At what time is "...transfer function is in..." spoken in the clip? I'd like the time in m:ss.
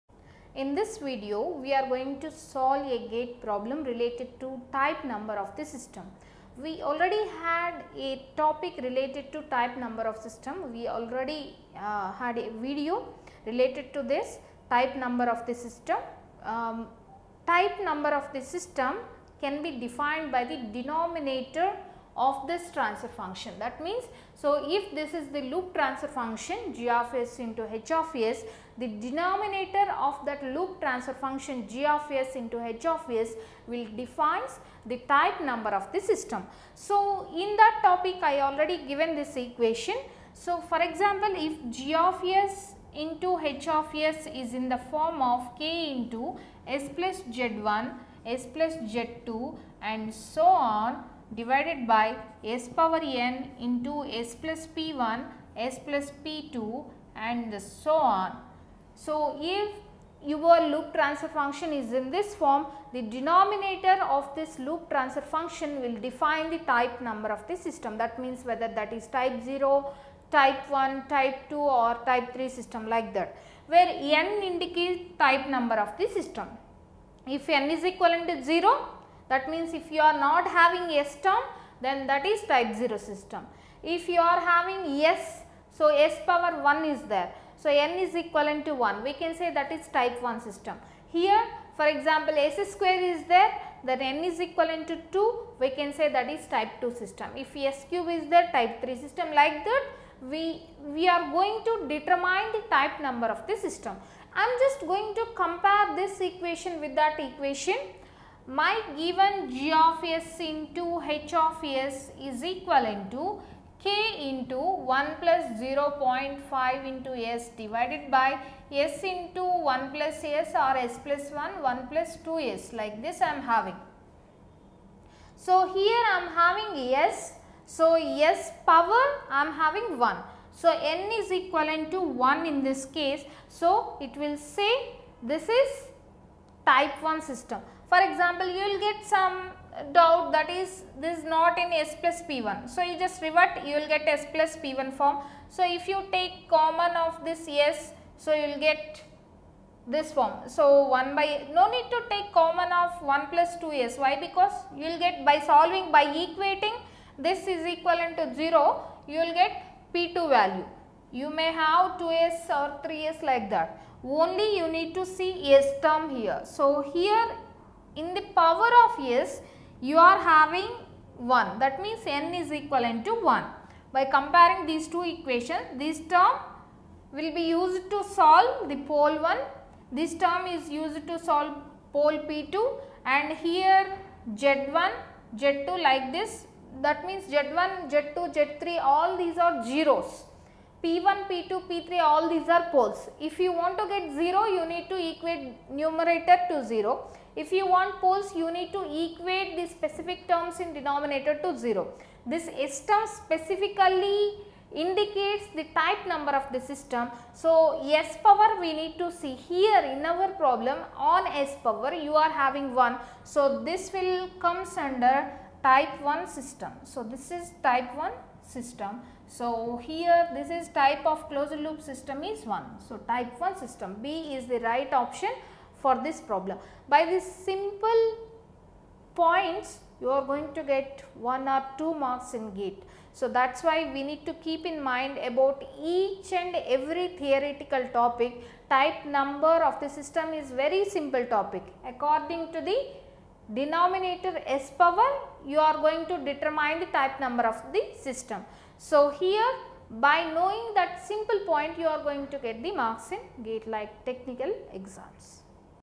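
1:00.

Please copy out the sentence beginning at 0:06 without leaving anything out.
We already had a topic related to type number of system.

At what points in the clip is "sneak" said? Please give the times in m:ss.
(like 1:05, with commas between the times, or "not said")
not said.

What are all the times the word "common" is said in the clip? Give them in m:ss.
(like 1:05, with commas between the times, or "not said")
2:26, 2:32.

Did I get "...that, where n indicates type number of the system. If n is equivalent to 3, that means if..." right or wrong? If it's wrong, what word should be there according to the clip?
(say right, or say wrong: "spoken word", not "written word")
wrong: "0", not "3".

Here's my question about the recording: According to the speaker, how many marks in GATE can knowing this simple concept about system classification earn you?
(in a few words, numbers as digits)
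1 or 2.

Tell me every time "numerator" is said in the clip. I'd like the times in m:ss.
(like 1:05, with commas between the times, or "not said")
3:15.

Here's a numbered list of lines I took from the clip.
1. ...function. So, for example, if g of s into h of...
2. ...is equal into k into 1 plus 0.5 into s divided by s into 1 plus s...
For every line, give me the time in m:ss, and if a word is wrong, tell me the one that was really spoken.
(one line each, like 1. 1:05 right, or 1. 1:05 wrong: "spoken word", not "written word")
1. 0:39 wrong: "equation", not "function"
2. 1:52 right.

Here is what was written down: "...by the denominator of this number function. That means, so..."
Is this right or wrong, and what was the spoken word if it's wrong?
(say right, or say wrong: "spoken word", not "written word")
wrong: "transfer", not "number".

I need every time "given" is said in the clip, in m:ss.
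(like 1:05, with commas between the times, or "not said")
0:38, 1:48.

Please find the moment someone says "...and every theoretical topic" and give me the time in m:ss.
3:56.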